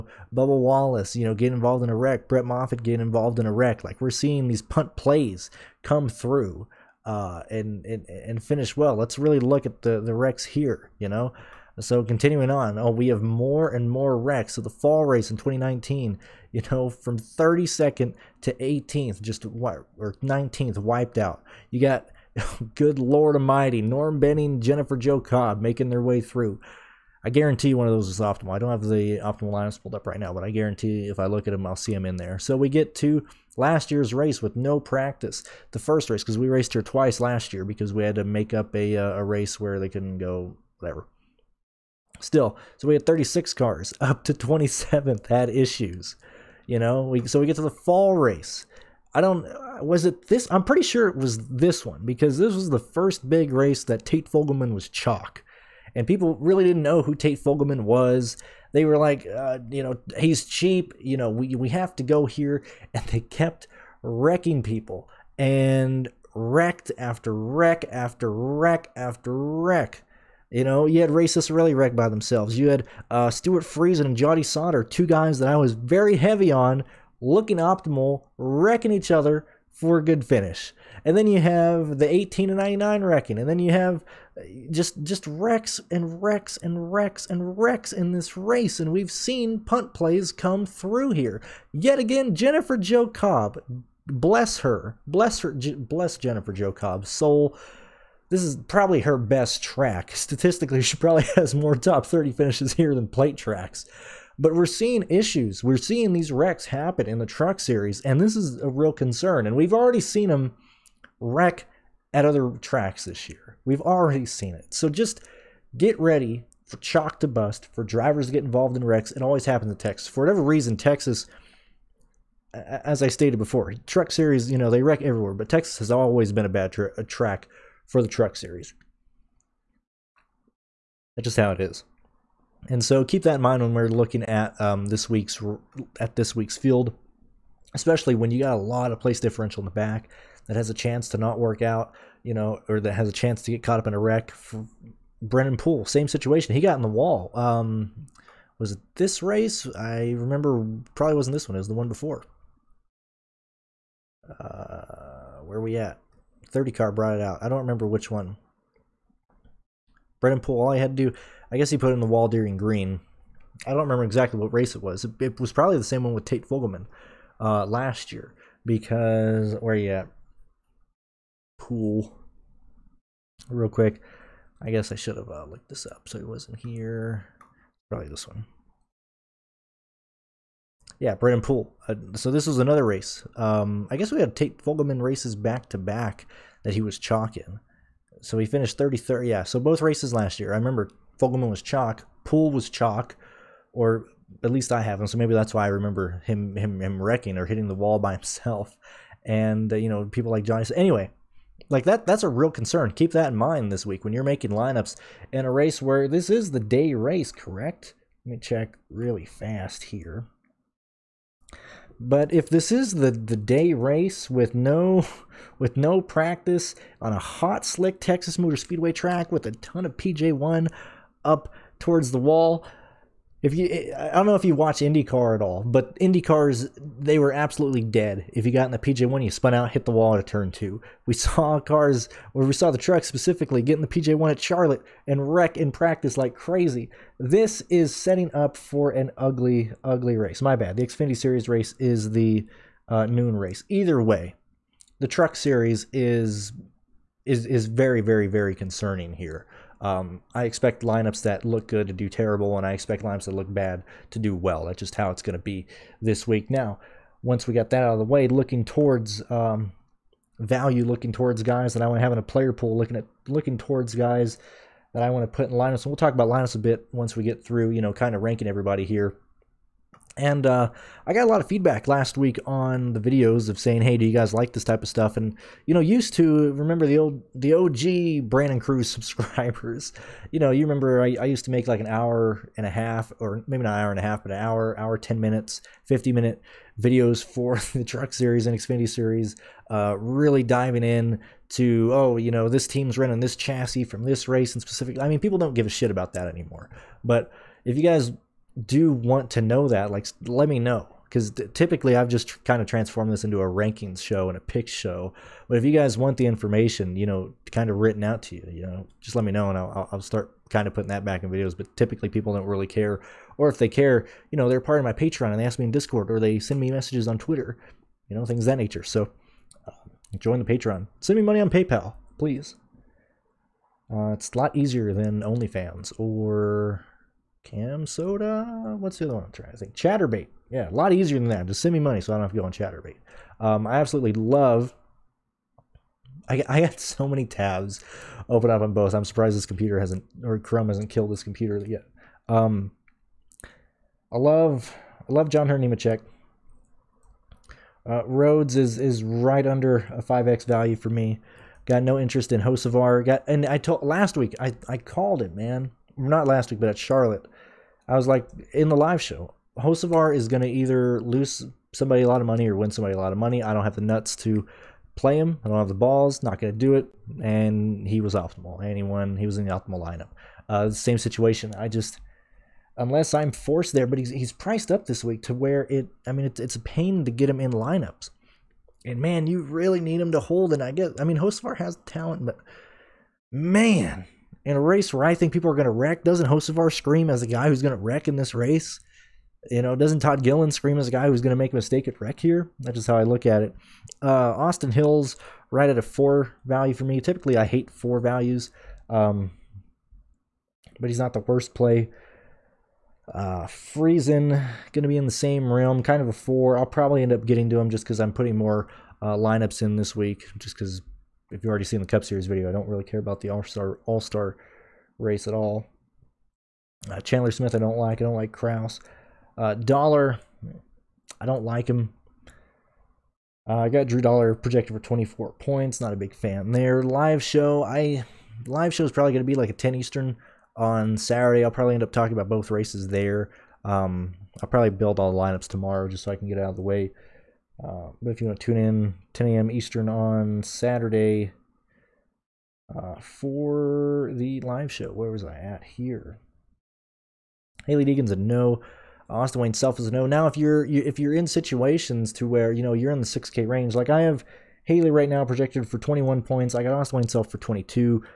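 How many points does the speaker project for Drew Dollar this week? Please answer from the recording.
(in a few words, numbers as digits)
24.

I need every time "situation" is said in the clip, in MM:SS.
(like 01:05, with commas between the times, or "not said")
02:26, 06:10, 07:31.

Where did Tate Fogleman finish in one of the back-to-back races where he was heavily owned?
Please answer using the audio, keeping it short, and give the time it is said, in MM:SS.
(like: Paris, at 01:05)
33rd, at 03:08.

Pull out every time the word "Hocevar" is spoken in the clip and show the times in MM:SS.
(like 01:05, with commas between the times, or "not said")
05:52, 05:59, 06:21, 06:26.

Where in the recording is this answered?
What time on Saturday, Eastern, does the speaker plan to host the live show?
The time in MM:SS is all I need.
07:19.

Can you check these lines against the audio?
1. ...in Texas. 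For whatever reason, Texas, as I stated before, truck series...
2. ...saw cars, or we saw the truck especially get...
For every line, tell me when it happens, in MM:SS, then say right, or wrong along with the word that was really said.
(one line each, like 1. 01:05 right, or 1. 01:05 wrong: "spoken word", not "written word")
1. 01:59 right
2. 03:51 wrong: "specifically", not "especially".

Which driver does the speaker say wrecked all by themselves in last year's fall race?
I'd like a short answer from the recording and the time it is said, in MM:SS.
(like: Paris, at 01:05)
Ray Ciccarelli, at 01:11.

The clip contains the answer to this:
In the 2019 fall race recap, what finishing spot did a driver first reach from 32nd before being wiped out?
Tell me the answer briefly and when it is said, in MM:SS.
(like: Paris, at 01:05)
18th, at 00:18.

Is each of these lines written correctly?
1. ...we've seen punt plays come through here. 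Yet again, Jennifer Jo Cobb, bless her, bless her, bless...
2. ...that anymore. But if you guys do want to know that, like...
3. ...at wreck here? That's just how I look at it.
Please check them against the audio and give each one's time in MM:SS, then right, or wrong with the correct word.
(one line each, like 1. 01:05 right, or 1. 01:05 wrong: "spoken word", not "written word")
1. 01:28 right
2. 04:56 right
3. 06:31 right.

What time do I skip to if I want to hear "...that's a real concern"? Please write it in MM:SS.
03:22.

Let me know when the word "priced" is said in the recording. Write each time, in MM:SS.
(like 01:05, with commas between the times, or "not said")
06:14.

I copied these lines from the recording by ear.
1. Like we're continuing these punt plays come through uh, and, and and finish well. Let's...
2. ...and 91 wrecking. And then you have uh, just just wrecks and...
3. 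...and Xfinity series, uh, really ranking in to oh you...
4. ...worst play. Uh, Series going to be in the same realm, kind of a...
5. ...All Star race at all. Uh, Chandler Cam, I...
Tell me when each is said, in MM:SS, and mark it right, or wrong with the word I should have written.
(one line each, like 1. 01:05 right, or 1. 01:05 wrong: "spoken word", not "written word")
1. 00:03 wrong: "seeing", not "continuing"
2. 01:22 wrong: "99", not "91"
3. 04:48 wrong: "diving", not "ranking"
4. 06:41 wrong: "Friesen", not "Series"
5. 06:53 wrong: "Smith", not "Cam".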